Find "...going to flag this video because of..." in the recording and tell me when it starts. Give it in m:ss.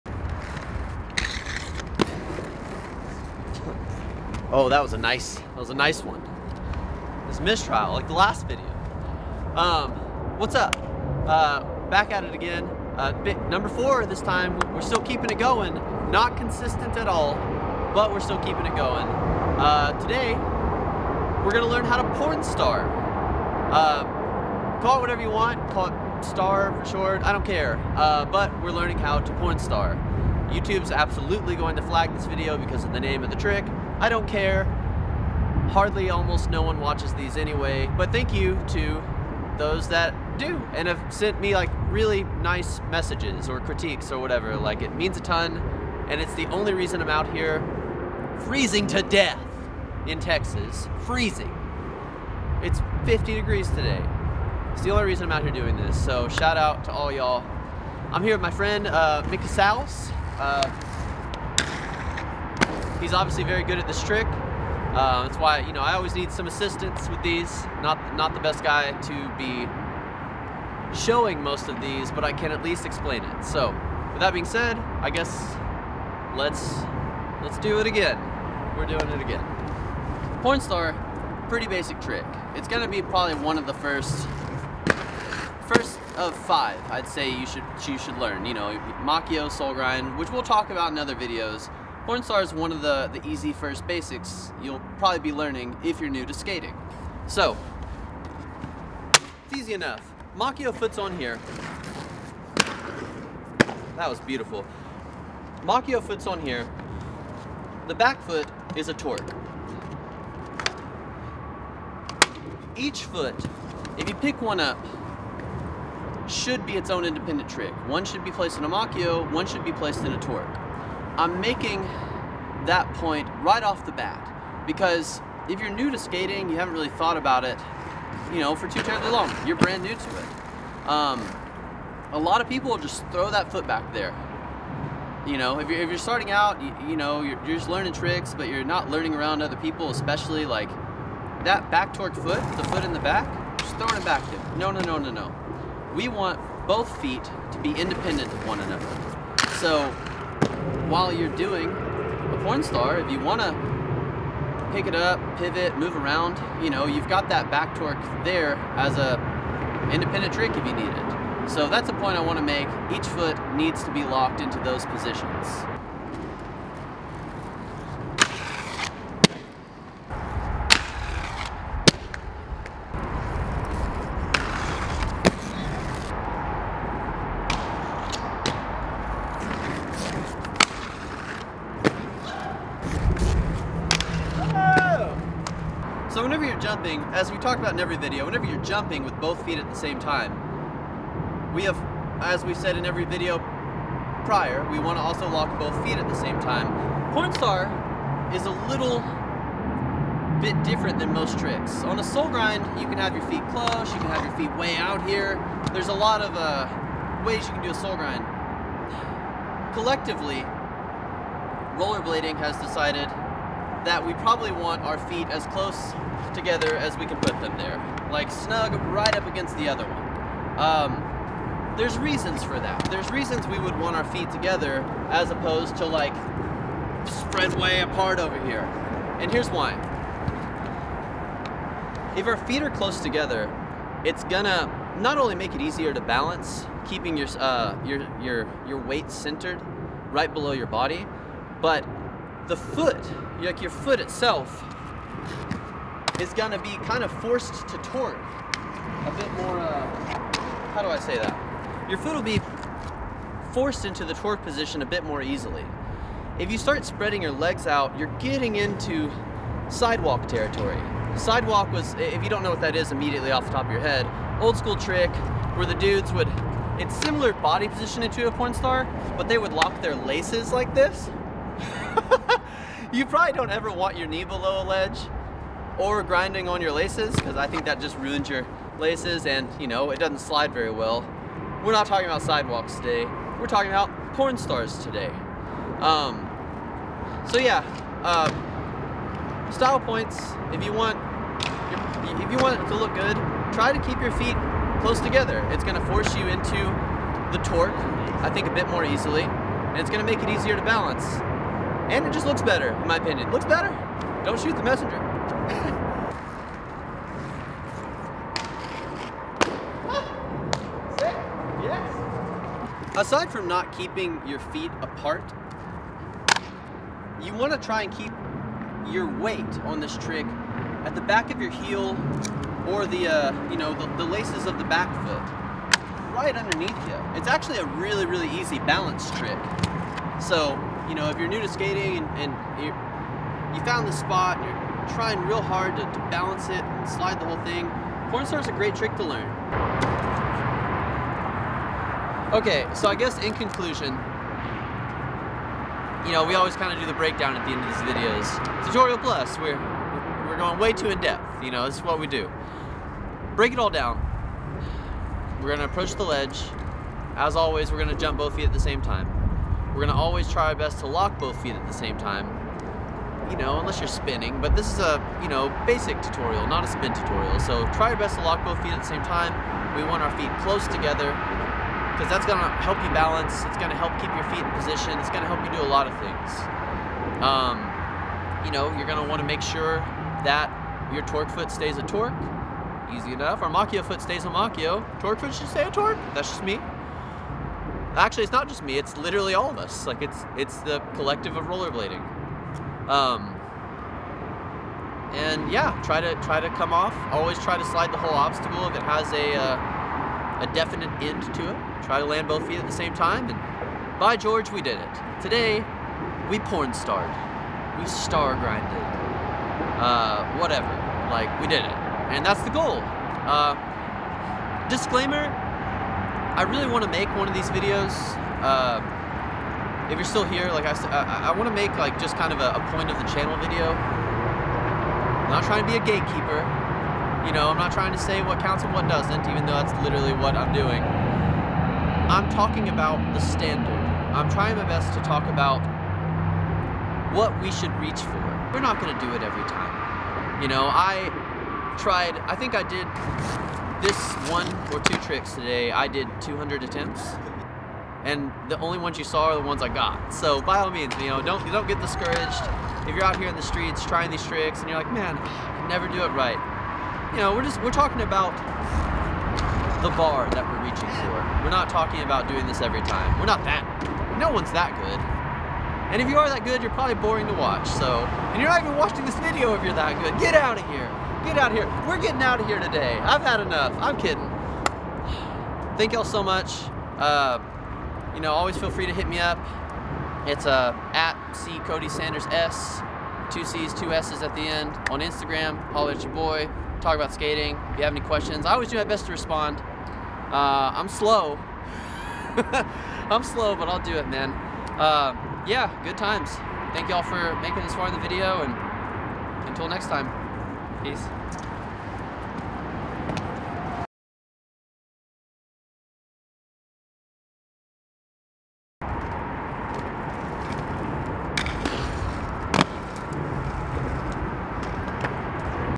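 0:31.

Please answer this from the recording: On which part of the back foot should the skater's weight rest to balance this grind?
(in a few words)
the laces.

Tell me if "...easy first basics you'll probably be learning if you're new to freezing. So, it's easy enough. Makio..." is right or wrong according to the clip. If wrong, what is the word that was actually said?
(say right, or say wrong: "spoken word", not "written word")
wrong: "skating", not "freezing".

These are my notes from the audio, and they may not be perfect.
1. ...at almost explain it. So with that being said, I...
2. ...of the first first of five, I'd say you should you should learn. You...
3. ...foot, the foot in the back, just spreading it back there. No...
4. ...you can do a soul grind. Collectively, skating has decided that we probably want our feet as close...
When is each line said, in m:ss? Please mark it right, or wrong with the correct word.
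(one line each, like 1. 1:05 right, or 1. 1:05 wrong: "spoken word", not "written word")
1. 1:12 wrong: "least", not "almost"
2. 1:23 right
3. 2:22 wrong: "throwing", not "spreading"
4. 3:27 wrong: "rollerblading", not "skating".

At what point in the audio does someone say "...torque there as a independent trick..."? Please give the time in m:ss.
2:37.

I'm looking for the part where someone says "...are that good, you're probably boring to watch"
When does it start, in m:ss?
7:46.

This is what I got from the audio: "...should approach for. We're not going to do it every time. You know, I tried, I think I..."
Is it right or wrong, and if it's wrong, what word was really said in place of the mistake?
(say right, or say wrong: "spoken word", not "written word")
wrong: "reach", not "approach".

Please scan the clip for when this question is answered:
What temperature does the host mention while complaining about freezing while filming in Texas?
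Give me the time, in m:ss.
0:53.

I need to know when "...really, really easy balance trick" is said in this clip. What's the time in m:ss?
5:27.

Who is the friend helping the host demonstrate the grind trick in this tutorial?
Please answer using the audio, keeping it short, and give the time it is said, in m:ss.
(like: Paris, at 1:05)
Mick Casals, at 0:59.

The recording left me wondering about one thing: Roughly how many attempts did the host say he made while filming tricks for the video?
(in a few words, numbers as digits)
200.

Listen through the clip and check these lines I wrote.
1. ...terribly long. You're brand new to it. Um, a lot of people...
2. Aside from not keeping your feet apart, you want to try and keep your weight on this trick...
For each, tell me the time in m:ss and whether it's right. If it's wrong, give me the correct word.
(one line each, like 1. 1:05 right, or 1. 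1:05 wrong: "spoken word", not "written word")
1. 2:08 right
2. 5:12 right.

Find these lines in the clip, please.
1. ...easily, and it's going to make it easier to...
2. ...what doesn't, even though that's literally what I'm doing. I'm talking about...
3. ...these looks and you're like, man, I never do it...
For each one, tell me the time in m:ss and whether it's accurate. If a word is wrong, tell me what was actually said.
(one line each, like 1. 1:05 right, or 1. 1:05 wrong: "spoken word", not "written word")
1. 4:58 right
2. 7:08 right
3. 7:34 wrong: "tricks", not "looks".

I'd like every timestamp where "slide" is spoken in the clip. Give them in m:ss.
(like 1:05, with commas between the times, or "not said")
4:40, 5:36, 6:37.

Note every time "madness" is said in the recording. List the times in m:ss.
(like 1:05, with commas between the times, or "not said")
not said.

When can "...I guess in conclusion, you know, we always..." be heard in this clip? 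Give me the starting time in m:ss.
5:42.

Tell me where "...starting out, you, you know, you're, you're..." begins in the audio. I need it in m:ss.
2:15.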